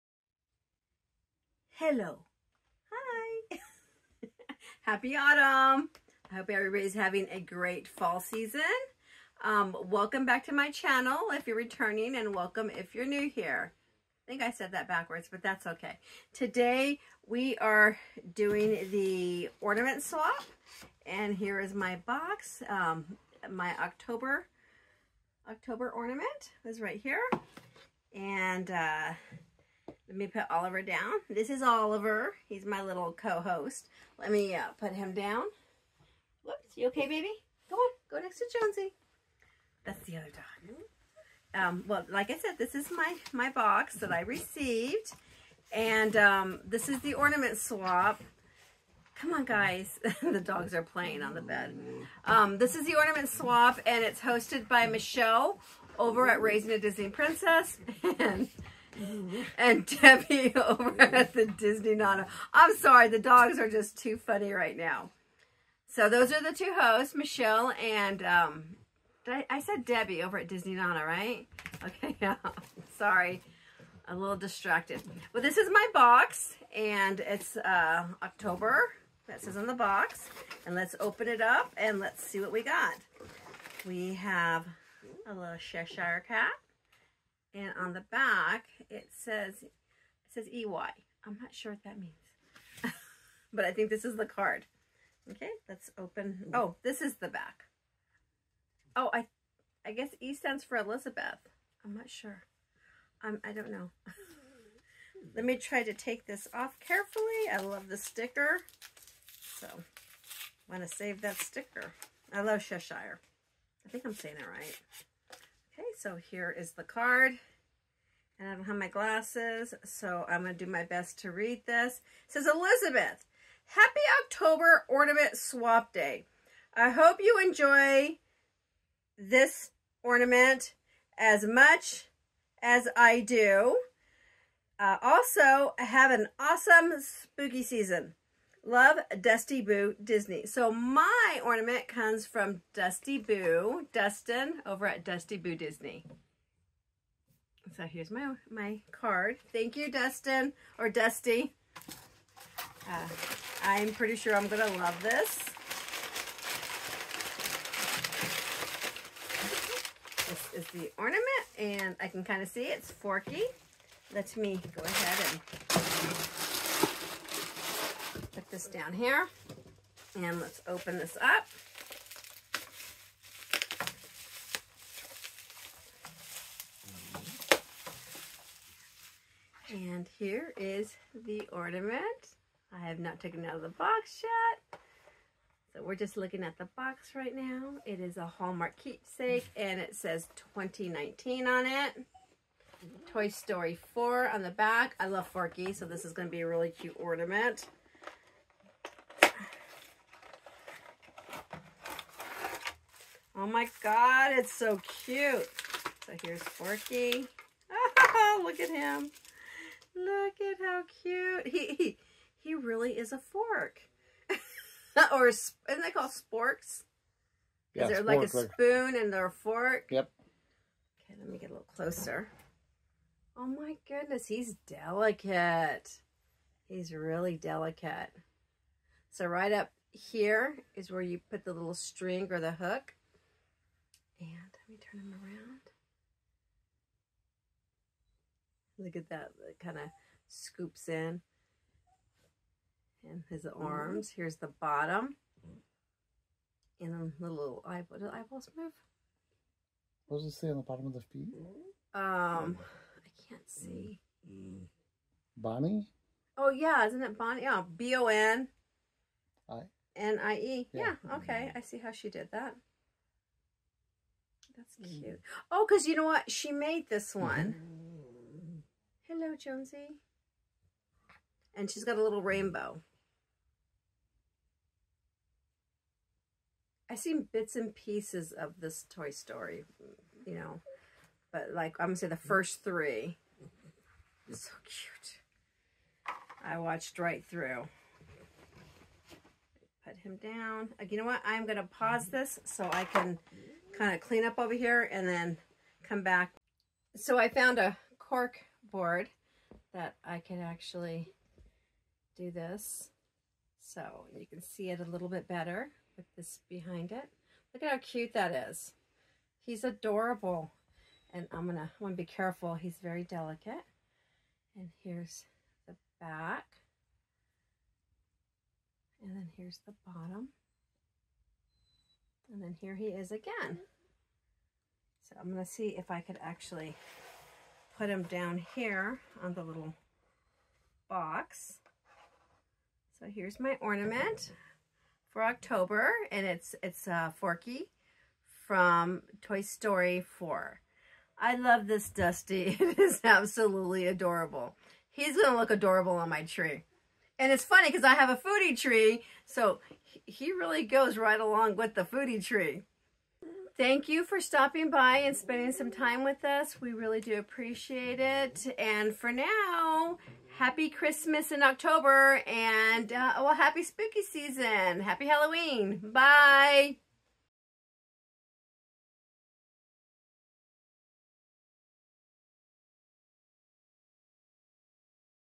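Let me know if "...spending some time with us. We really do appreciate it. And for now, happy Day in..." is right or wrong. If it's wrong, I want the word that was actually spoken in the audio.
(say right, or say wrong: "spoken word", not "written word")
wrong: "Christmas", not "Day".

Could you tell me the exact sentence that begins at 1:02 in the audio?
I'm sorry, the dogs are just too funny right now.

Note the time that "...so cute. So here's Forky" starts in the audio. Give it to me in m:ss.
3:24.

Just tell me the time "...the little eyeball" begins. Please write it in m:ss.
4:07.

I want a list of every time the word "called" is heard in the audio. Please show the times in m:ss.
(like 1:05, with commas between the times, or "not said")
3:35.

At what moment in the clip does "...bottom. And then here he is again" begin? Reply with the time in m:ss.
5:19.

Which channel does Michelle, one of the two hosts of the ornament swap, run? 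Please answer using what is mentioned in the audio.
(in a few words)
Raising a Disney Princess.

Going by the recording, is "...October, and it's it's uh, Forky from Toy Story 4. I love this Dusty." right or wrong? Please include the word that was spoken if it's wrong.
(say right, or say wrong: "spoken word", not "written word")
right.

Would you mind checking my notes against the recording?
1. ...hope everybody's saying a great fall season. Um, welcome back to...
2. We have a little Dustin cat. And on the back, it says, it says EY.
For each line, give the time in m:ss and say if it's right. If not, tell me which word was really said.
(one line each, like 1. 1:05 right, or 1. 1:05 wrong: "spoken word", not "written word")
1. 0:06 wrong: "having", not "saying"
2. 1:23 wrong: "Cheshire", not "Dustin".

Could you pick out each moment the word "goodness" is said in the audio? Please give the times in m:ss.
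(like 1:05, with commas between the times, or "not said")
3:43.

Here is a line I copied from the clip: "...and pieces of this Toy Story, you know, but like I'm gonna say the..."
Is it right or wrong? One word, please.
right.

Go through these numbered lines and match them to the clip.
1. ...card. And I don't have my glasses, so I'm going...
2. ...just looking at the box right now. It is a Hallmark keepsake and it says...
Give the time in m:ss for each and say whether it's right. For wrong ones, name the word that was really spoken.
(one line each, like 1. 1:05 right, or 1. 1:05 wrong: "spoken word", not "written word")
1. 1:56 right
2. 3:05 right.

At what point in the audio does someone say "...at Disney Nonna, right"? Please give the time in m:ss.
1:10.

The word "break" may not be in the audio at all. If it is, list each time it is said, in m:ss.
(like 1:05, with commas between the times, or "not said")
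not said.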